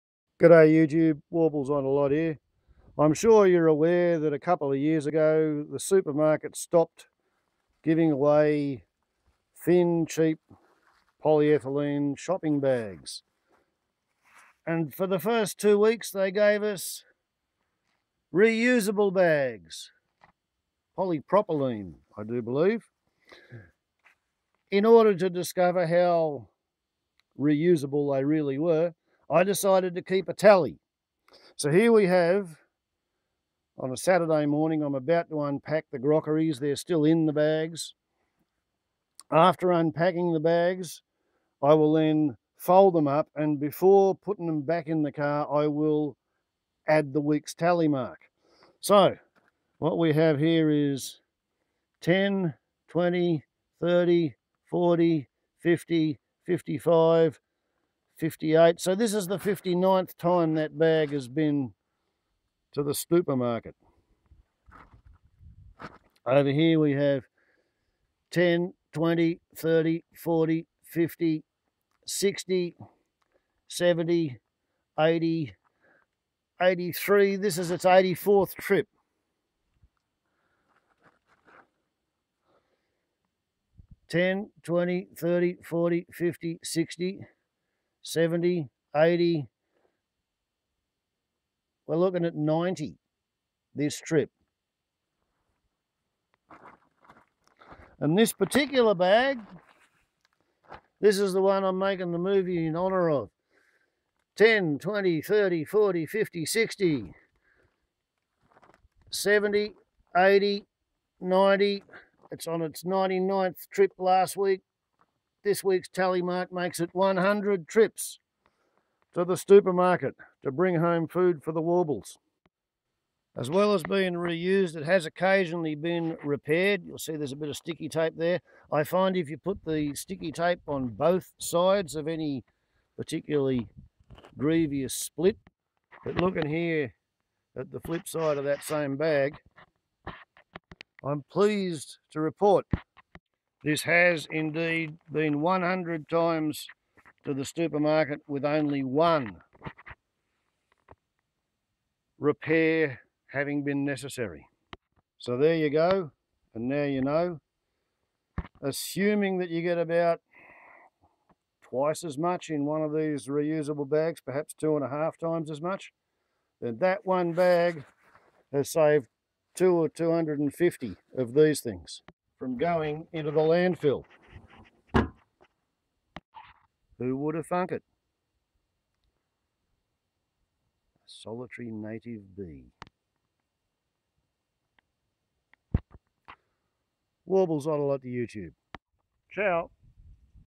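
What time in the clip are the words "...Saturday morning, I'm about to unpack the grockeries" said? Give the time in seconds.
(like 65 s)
33 s.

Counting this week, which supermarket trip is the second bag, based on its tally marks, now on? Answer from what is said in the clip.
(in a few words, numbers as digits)
84th.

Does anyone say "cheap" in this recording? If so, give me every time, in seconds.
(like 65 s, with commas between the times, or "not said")
10 s.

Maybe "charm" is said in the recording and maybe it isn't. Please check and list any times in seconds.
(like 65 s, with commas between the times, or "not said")
not said.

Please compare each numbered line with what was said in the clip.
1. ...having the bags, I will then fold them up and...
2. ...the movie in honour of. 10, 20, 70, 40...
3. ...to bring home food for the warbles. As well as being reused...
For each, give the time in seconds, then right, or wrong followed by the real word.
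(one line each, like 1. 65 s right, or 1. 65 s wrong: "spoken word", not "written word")
1. 39 s wrong: "unpacking", not "having"
2. 102 s wrong: "30", not "70"
3. 120 s right.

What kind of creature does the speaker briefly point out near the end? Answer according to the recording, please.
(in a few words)
A solitary native bee.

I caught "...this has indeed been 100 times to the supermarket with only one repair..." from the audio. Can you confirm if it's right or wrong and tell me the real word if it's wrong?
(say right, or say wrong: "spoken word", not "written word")
right.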